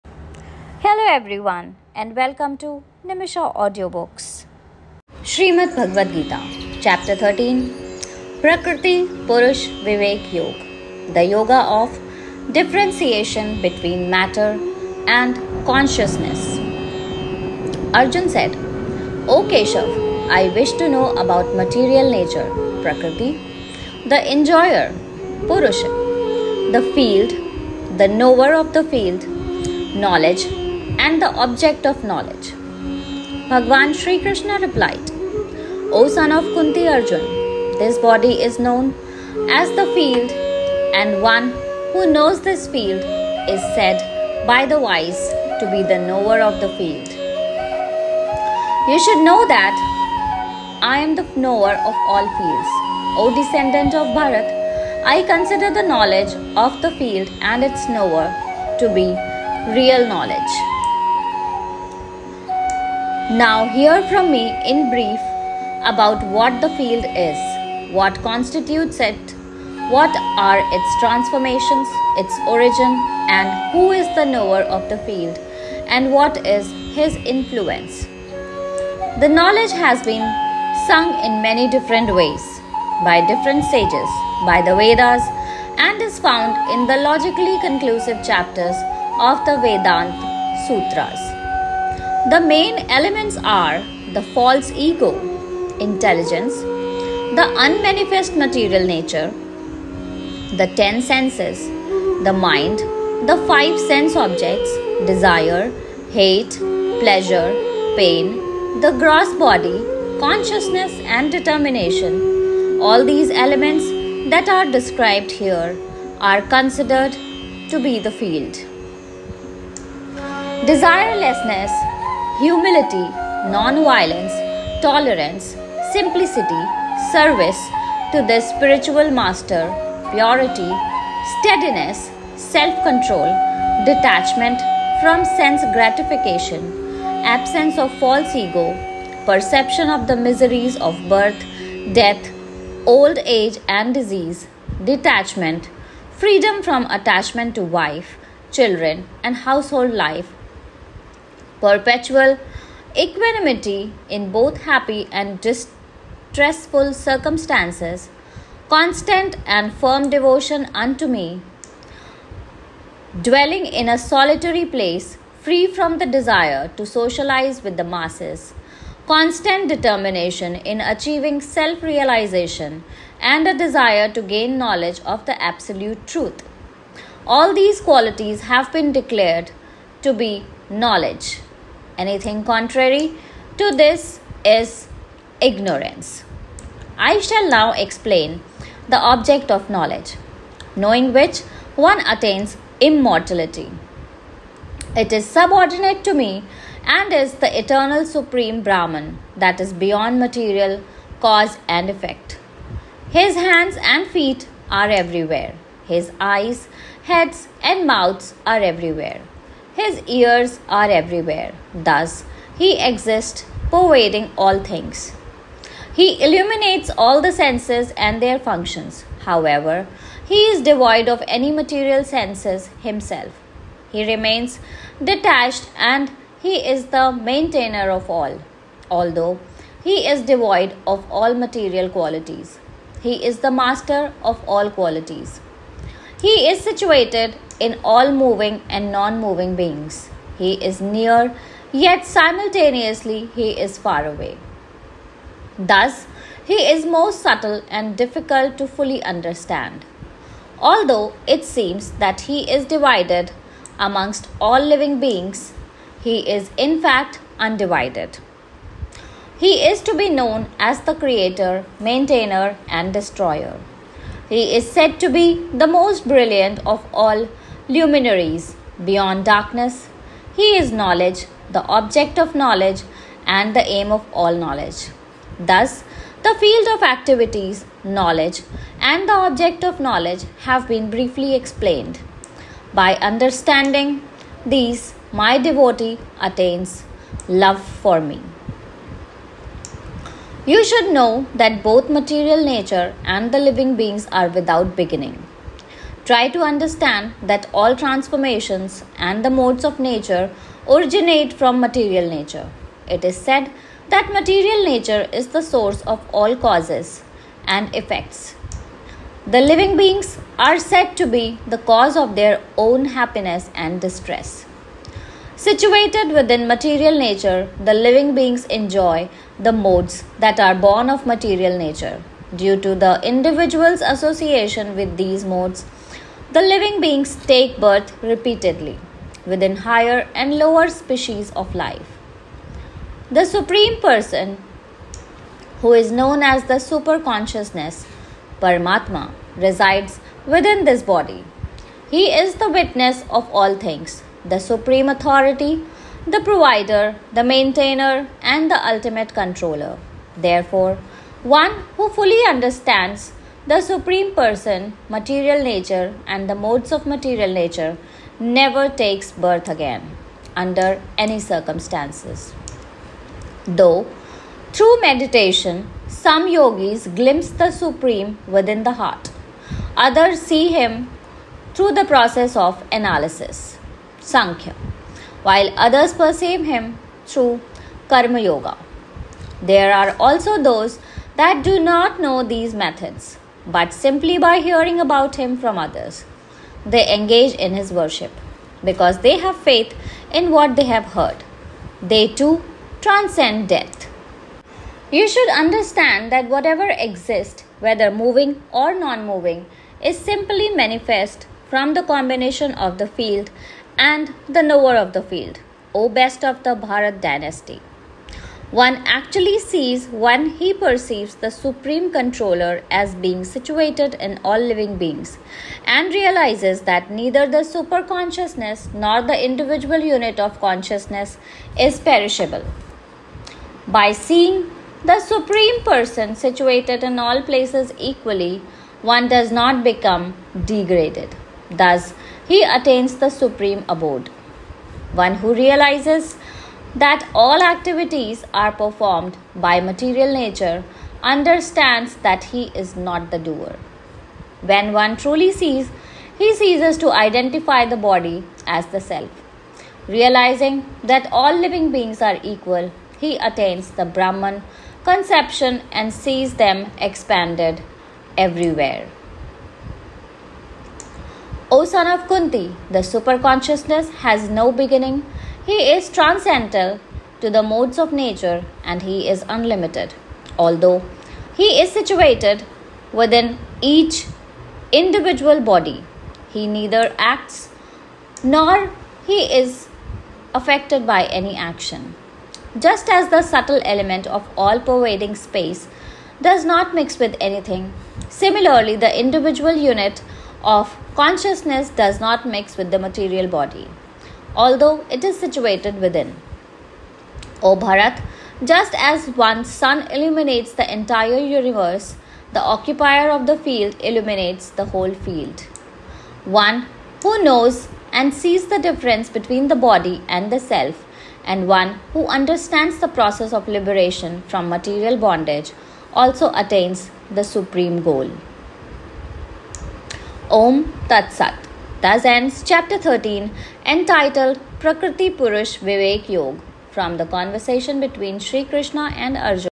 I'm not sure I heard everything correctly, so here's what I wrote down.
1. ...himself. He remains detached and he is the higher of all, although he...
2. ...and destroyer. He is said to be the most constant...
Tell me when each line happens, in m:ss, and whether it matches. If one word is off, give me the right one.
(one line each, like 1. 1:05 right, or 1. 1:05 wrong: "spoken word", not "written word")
1. 3:42 wrong: "maintainer", not "higher"
2. 4:22 wrong: "brilliant", not "constant".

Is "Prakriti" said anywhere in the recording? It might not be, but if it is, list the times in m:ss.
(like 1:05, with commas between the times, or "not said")
0:08, 0:22, 8:44.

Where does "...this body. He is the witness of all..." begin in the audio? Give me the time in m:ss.
5:40.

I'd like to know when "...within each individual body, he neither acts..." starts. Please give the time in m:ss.
7:52.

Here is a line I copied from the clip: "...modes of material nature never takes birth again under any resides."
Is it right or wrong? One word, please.
wrong.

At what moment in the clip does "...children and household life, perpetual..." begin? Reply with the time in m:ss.
2:28.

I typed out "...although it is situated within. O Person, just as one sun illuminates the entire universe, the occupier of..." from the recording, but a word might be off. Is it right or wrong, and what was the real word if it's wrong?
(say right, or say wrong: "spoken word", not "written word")
wrong: "Bharat", not "Person".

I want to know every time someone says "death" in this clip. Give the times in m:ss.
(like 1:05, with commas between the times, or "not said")
2:21, 6:33.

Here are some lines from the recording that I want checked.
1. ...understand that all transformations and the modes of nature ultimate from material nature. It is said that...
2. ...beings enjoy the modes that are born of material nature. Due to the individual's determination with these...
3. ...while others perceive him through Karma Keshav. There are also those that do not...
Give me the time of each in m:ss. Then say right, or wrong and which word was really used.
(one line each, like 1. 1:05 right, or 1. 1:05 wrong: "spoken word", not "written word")
1. 4:56 wrong: "originate", not "ultimate"
2. 5:18 wrong: "association", not "determination"
3. 6:15 wrong: "Yoga", not "Keshav".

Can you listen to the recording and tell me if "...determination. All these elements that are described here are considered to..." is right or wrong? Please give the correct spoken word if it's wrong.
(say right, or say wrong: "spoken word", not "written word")
right.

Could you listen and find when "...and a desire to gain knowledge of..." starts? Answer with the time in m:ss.
2:53.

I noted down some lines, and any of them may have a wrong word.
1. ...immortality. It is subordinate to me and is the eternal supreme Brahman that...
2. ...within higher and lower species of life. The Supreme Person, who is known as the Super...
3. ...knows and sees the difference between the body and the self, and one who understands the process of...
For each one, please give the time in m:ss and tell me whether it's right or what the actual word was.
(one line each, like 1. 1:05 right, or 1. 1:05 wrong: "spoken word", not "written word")
1. 3:12 right
2. 5:29 right
3. 8:27 right.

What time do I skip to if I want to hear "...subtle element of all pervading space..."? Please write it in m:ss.
8:03.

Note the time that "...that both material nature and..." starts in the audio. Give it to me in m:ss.
4:51.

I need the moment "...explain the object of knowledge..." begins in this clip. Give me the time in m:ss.
3:07.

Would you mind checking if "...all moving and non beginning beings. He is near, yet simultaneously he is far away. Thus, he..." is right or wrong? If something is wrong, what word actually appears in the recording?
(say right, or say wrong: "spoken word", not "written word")
wrong: "moving", not "beginning".